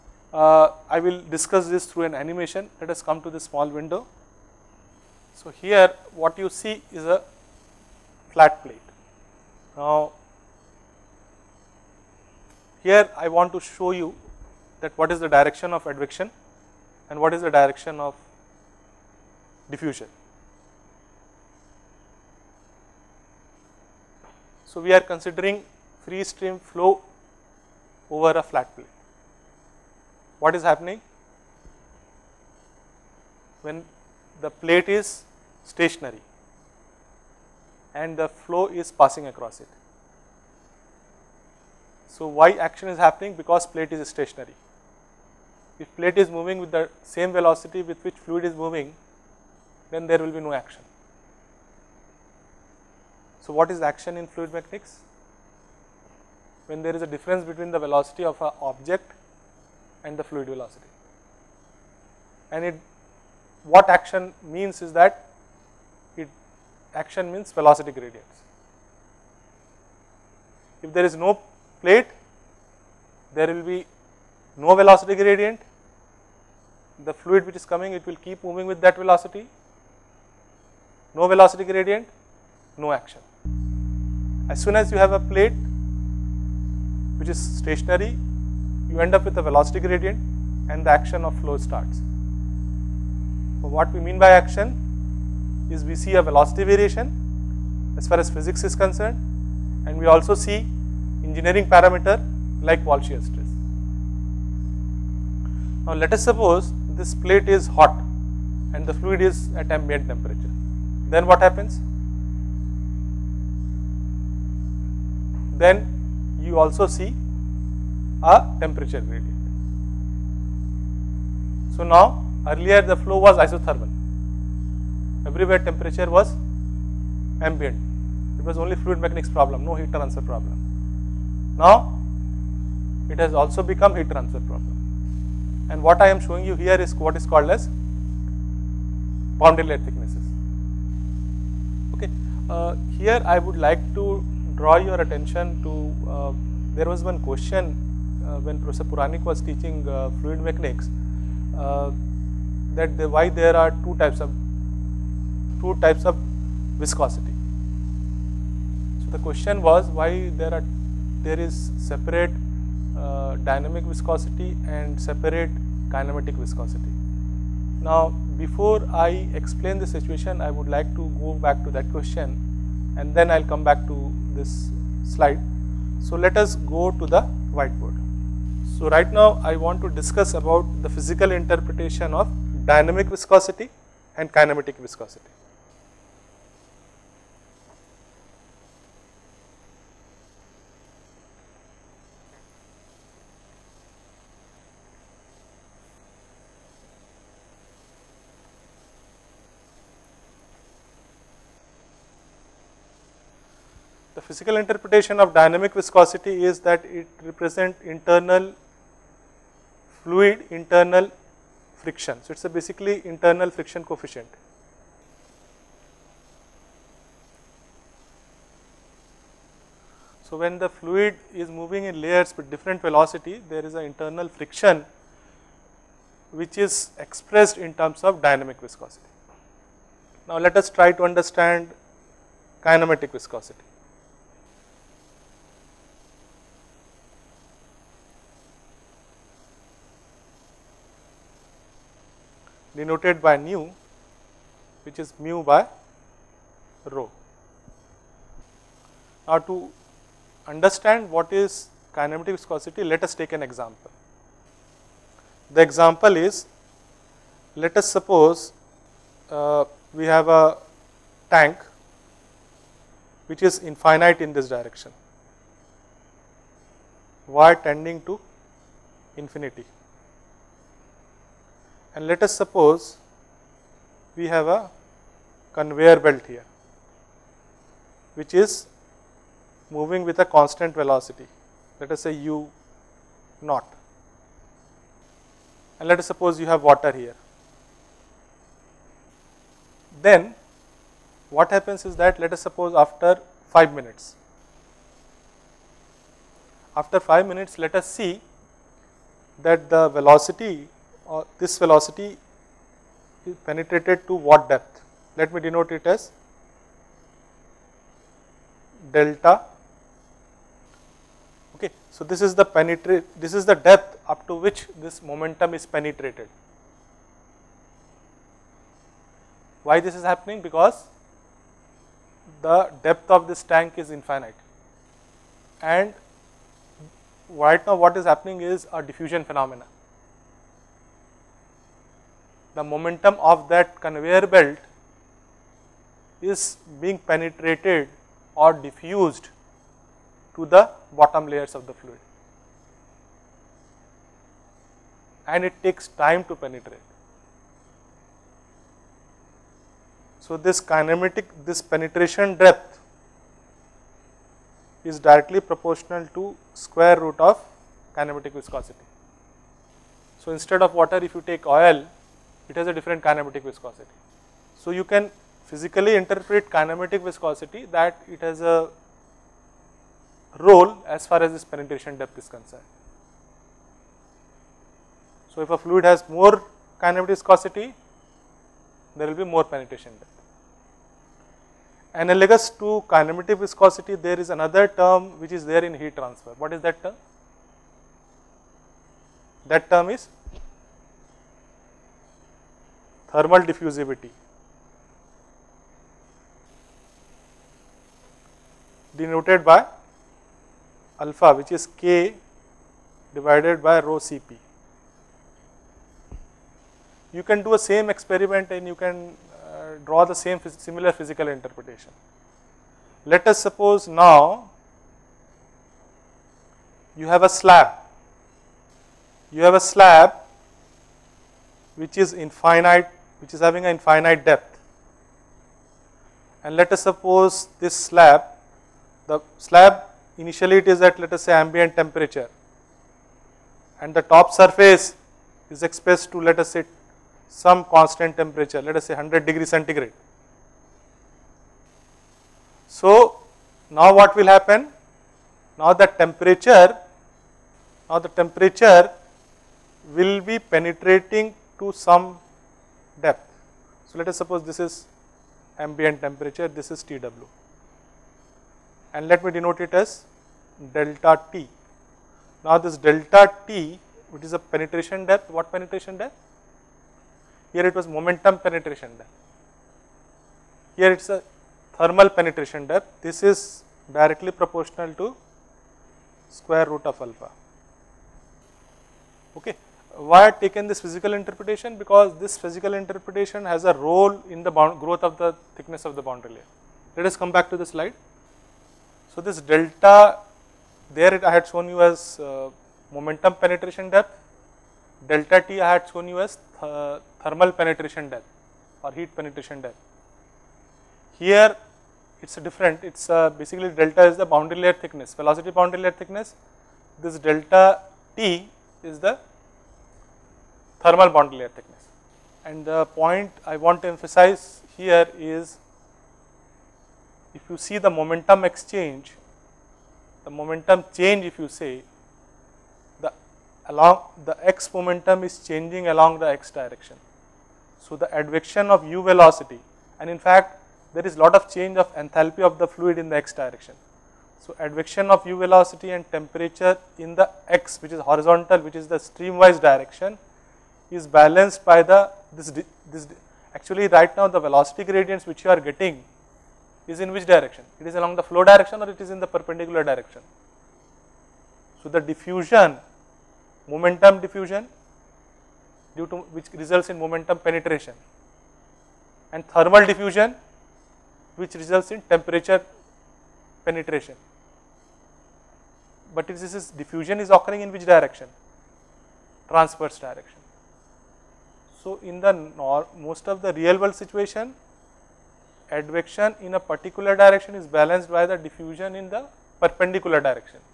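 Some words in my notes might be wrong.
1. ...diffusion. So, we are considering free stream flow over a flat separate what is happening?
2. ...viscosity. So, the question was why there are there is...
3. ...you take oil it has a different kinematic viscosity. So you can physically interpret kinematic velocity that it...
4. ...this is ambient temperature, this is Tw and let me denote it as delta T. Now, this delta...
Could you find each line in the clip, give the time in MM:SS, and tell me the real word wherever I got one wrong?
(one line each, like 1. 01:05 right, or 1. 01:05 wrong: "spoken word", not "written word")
1. 00:19 wrong: "plate", not "separate"
2. 02:36 right
3. 06:01 wrong: "viscosity", not "velocity"
4. 07:34 right.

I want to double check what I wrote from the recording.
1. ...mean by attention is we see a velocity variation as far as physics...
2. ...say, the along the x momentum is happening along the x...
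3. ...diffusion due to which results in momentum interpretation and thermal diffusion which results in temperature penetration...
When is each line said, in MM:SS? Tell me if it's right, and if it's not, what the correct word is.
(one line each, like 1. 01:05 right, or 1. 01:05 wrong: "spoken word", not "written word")
1. 01:34 wrong: "action", not "attention"
2. 08:41 wrong: "changing", not "happening"
3. 09:14 wrong: "penetration", not "interpretation".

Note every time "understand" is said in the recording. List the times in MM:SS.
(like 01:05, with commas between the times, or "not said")
03:51, 04:10.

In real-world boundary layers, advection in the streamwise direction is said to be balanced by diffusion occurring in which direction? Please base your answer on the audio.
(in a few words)
Transverse direction.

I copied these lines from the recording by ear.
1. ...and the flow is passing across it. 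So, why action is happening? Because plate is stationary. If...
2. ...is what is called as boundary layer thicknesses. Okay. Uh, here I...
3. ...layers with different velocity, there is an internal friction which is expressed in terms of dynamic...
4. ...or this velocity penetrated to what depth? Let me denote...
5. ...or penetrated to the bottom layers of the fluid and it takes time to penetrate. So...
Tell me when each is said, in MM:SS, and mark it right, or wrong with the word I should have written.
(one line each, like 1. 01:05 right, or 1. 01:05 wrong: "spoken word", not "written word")
1. 00:37 right
2. 02:16 right
3. 03:42 right
4. 05:01 right
5. 05:38 wrong: "diffused", not "penetrated".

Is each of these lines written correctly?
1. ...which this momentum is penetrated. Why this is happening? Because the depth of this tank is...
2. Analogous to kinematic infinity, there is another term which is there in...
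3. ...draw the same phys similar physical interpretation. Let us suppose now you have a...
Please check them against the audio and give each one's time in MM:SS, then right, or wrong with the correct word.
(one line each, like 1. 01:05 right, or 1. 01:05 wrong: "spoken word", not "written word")
1. 05:14 right
2. 06:21 wrong: "viscosity", not "infinity"
3. 06:49 right.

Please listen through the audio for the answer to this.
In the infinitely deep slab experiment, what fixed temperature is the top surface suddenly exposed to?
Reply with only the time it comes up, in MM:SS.
07:18.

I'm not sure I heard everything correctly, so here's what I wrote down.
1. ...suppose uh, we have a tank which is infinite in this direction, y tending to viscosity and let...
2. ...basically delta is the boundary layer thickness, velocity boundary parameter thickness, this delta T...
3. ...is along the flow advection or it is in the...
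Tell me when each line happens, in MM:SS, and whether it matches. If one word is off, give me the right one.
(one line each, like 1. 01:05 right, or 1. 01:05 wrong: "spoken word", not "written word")
1. 04:17 wrong: "infinity", not "viscosity"
2. 08:23 wrong: "layer", not "parameter"
3. 09:07 wrong: "direction", not "advection".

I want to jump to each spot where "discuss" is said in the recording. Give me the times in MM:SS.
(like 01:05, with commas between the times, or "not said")
00:01, 02:59.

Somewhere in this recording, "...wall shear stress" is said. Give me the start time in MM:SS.
01:42.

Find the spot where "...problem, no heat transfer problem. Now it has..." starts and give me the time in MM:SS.
02:09.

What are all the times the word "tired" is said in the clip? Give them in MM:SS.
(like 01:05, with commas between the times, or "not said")
not said.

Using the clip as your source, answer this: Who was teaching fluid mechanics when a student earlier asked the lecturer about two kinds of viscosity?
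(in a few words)
Professor Puranik.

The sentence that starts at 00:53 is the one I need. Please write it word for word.
So, what is action in fluid mechanics?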